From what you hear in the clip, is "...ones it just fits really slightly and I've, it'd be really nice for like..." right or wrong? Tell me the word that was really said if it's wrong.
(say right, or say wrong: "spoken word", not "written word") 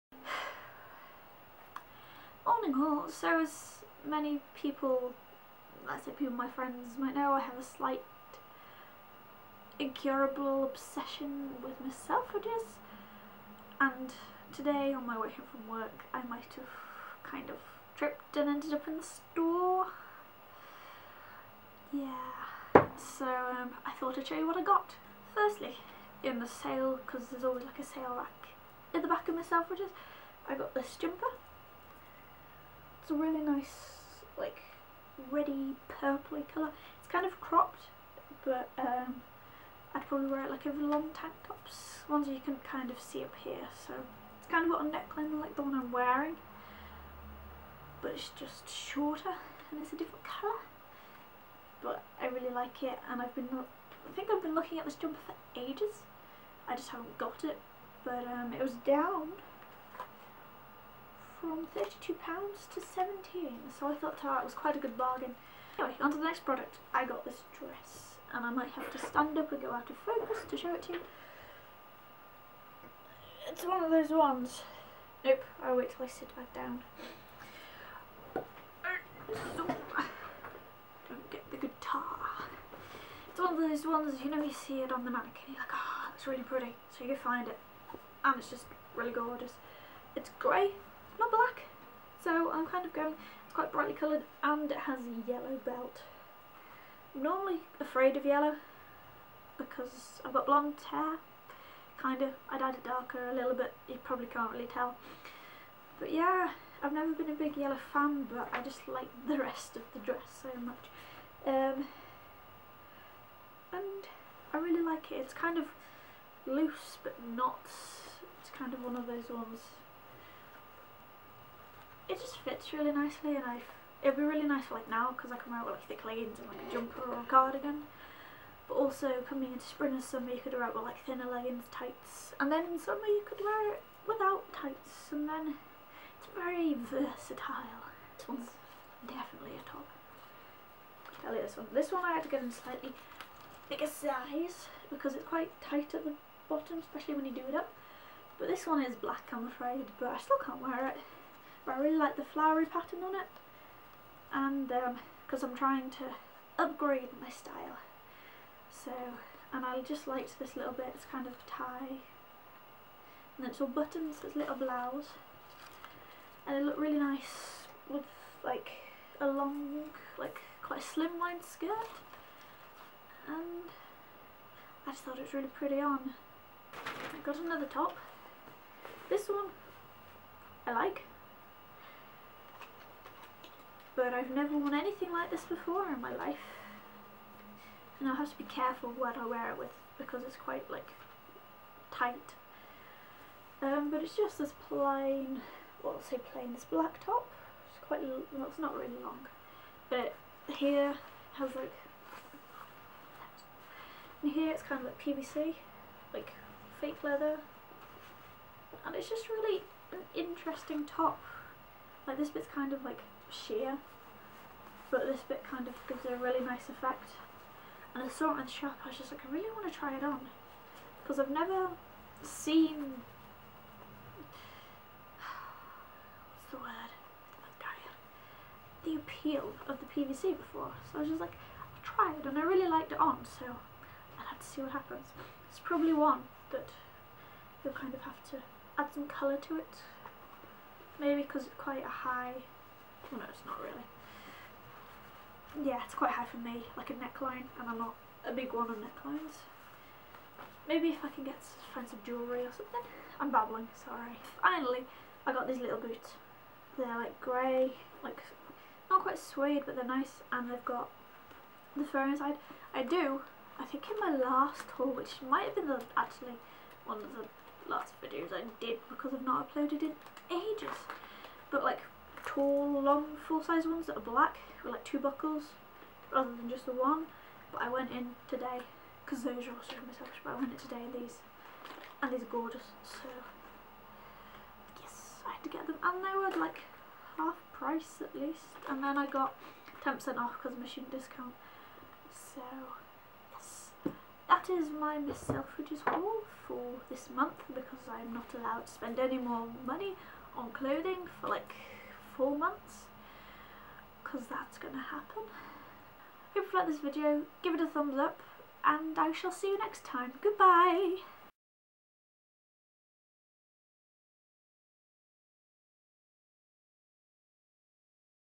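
wrong: "nicely", not "slightly".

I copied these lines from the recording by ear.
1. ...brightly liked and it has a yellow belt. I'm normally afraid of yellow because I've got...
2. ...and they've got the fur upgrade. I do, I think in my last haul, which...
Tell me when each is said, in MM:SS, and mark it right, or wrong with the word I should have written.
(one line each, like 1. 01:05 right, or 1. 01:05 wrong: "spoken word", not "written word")
1. 01:33 wrong: "coloured", not "liked"
2. 04:20 wrong: "inside", not "upgrade".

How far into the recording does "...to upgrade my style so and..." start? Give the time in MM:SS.
02:35.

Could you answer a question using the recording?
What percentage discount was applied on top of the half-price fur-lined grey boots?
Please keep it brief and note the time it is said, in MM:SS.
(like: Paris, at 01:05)
10%, at 04:49.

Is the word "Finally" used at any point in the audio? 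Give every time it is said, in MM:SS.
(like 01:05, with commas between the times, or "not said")
04:14.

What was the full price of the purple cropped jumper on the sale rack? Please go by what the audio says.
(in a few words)
£32.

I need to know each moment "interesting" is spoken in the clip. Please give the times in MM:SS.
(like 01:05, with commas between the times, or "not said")
03:30.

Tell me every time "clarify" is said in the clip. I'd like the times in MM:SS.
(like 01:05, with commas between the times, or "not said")
not said.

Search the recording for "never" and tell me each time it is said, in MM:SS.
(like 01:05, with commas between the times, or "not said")
01:46, 03:04, 03:41.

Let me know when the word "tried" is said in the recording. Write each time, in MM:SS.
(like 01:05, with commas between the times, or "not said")
03:51.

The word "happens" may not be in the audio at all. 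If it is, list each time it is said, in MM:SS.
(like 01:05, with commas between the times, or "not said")
03:54, 05:04.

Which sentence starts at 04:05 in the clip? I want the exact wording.
Yeah, it's quite high for me, like a neckline, and I'm not a big one on necklines.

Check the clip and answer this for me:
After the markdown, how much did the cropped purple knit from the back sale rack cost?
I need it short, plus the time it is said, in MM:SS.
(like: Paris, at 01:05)
£17, at 01:02.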